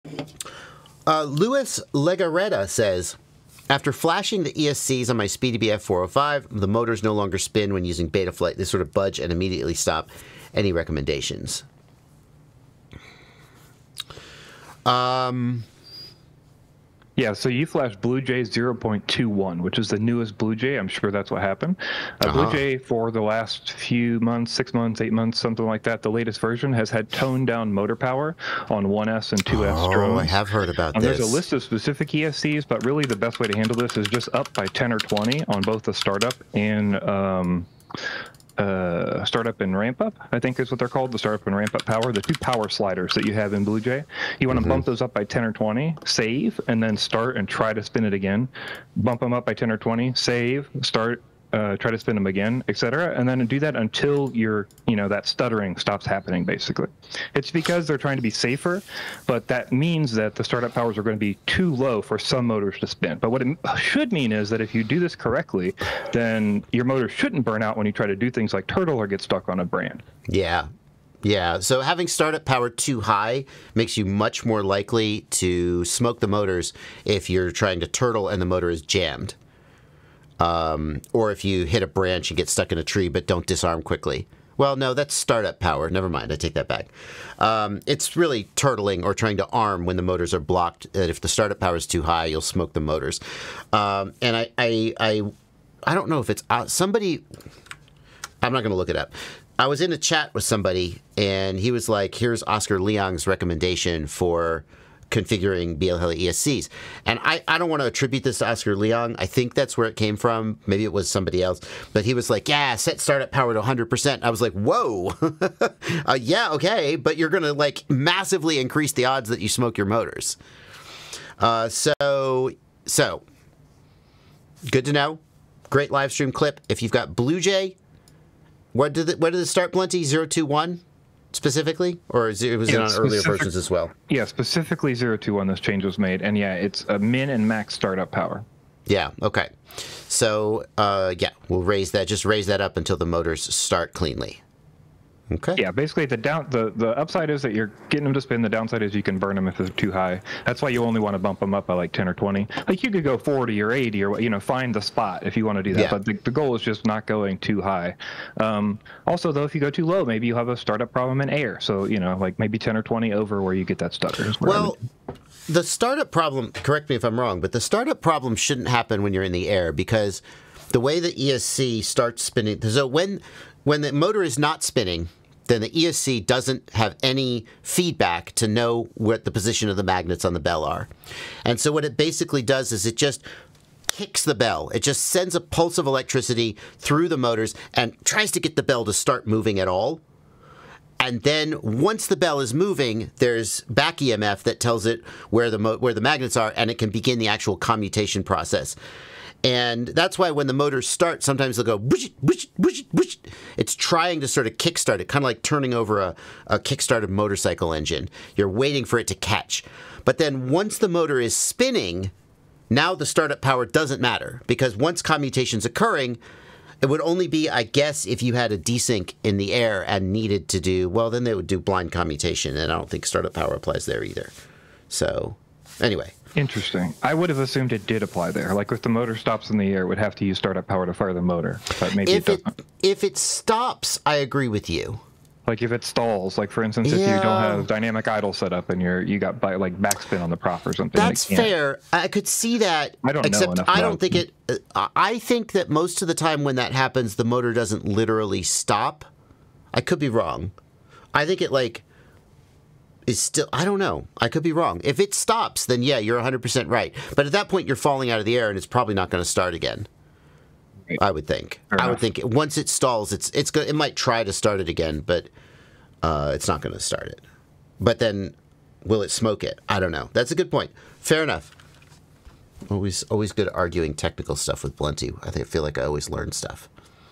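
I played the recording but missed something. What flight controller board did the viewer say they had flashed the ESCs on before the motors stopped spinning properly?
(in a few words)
bf 405.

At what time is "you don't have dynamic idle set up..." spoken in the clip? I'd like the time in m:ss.
3:57.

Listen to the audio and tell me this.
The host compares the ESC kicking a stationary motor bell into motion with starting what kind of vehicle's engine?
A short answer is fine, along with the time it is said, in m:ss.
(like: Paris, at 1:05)
kickstarted motorcycle, at 3:26.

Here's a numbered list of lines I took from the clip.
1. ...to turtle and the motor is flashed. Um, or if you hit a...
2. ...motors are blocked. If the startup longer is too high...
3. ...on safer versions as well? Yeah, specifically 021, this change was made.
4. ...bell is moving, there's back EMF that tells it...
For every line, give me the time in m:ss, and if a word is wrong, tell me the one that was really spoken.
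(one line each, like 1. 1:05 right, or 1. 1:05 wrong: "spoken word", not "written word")
1. 1:17 wrong: "jammed", not "flashed"
2. 1:30 wrong: "power", not "longer"
3. 2:12 wrong: "earlier", not "safer"
4. 3:12 right.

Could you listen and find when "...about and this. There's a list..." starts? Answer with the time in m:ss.
0:30.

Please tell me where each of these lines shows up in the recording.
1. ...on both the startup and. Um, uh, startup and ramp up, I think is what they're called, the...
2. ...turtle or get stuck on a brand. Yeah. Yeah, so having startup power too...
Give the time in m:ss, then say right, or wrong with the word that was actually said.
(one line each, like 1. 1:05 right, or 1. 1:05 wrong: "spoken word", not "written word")
1. 0:35 right
2. 1:08 right.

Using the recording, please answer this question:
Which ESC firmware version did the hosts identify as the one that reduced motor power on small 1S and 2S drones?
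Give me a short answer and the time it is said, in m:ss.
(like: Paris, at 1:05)
Bluejay 0.21, at 0:18.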